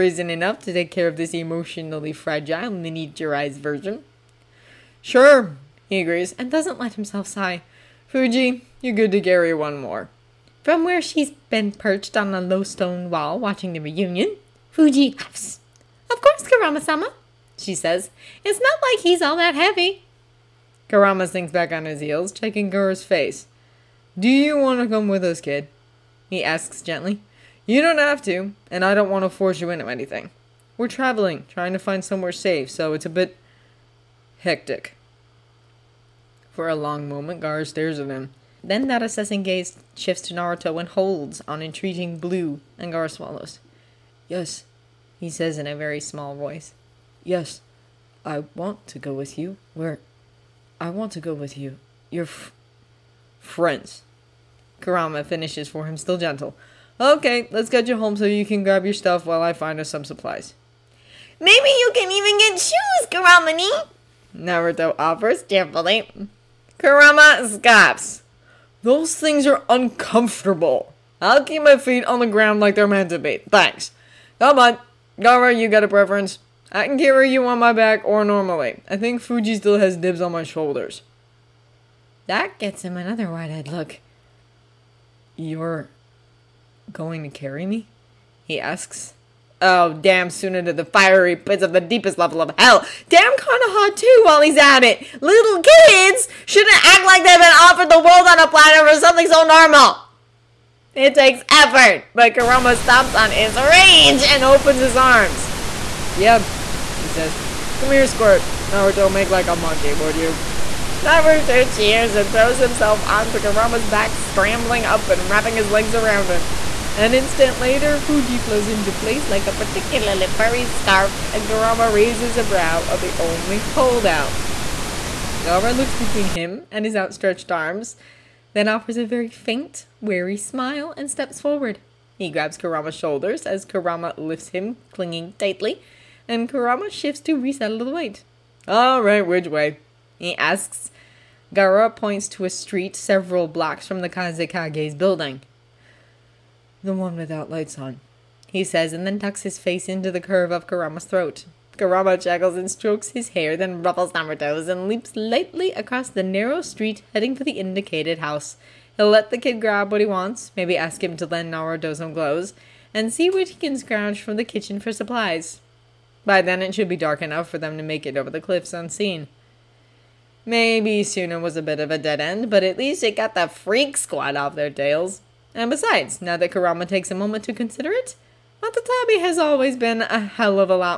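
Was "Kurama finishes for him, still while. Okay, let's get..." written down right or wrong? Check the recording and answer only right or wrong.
wrong.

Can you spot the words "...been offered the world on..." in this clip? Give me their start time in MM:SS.
01:37.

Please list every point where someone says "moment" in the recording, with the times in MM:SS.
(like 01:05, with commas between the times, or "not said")
00:37, 02:57.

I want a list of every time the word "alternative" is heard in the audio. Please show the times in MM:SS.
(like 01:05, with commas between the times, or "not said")
not said.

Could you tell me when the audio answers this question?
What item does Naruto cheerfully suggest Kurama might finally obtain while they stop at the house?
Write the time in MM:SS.
01:02.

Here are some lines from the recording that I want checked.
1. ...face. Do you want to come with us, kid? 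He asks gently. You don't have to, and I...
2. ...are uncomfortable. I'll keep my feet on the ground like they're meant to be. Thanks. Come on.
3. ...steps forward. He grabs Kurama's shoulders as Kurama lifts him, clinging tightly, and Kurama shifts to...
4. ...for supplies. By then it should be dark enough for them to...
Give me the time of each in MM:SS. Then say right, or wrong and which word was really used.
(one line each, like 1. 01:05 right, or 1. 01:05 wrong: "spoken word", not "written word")
1. 00:23 right
2. 01:09 right
3. 02:11 right
4. 02:44 right.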